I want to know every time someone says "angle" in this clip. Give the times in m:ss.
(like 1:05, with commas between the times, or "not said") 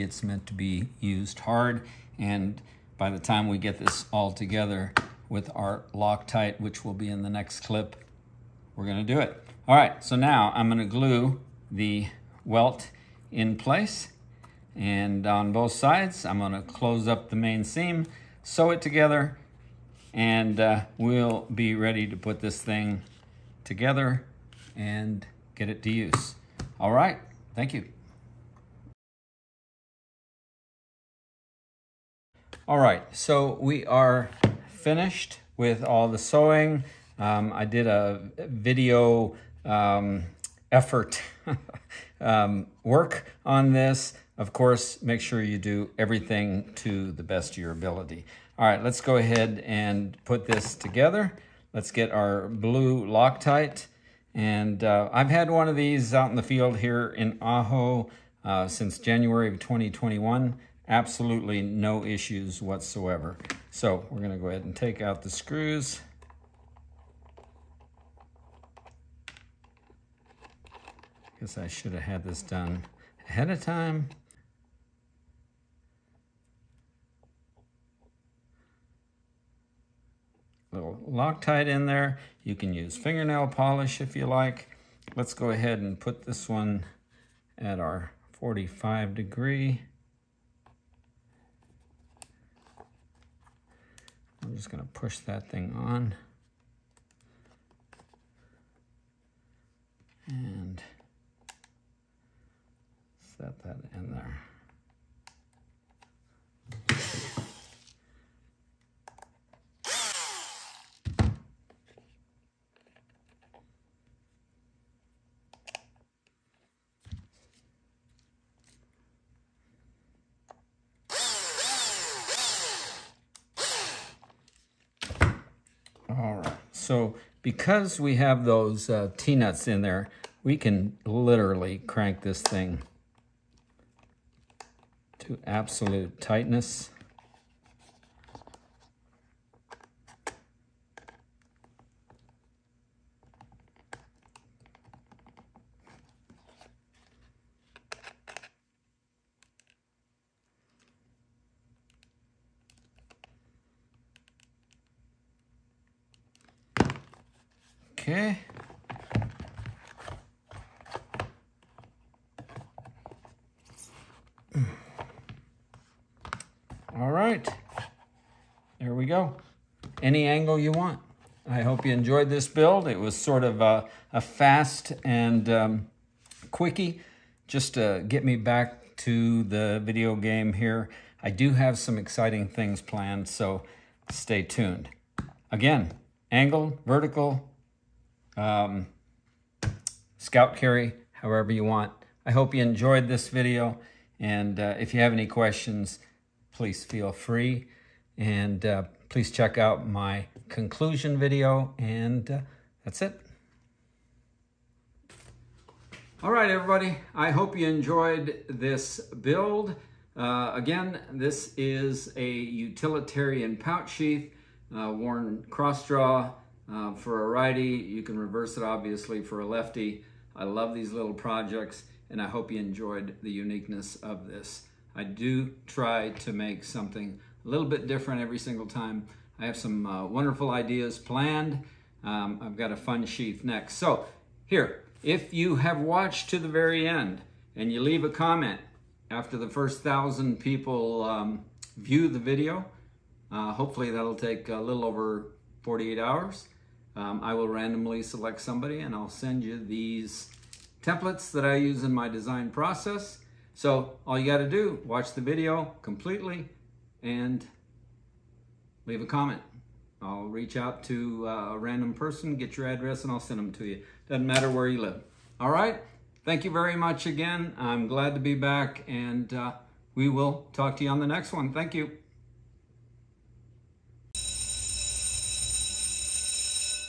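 2:50, 3:06.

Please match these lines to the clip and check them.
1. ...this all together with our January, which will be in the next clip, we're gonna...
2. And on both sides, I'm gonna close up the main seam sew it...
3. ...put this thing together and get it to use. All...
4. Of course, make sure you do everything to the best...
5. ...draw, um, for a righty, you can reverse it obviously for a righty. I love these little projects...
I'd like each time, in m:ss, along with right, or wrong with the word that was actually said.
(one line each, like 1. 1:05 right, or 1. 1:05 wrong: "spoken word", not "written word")
1. 0:03 wrong: "Loctite", not "January"
2. 0:14 right
3. 0:22 right
4. 0:44 right
5. 3:35 wrong: "lefty", not "righty".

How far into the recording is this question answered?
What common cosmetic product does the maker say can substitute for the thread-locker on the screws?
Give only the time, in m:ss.
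1:22.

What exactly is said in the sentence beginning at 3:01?
I do have some exciting things planned, so stay tuned.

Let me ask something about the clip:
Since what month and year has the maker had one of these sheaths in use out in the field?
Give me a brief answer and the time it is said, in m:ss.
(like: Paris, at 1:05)
January 2021, at 0:58.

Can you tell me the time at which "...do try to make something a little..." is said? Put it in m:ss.
3:45.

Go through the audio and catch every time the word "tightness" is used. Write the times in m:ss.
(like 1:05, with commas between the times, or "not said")
2:16.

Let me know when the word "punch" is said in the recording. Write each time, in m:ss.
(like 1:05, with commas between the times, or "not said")
not said.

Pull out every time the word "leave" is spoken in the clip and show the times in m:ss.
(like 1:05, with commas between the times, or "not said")
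3:57, 4:18.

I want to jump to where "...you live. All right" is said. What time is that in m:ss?
4:24.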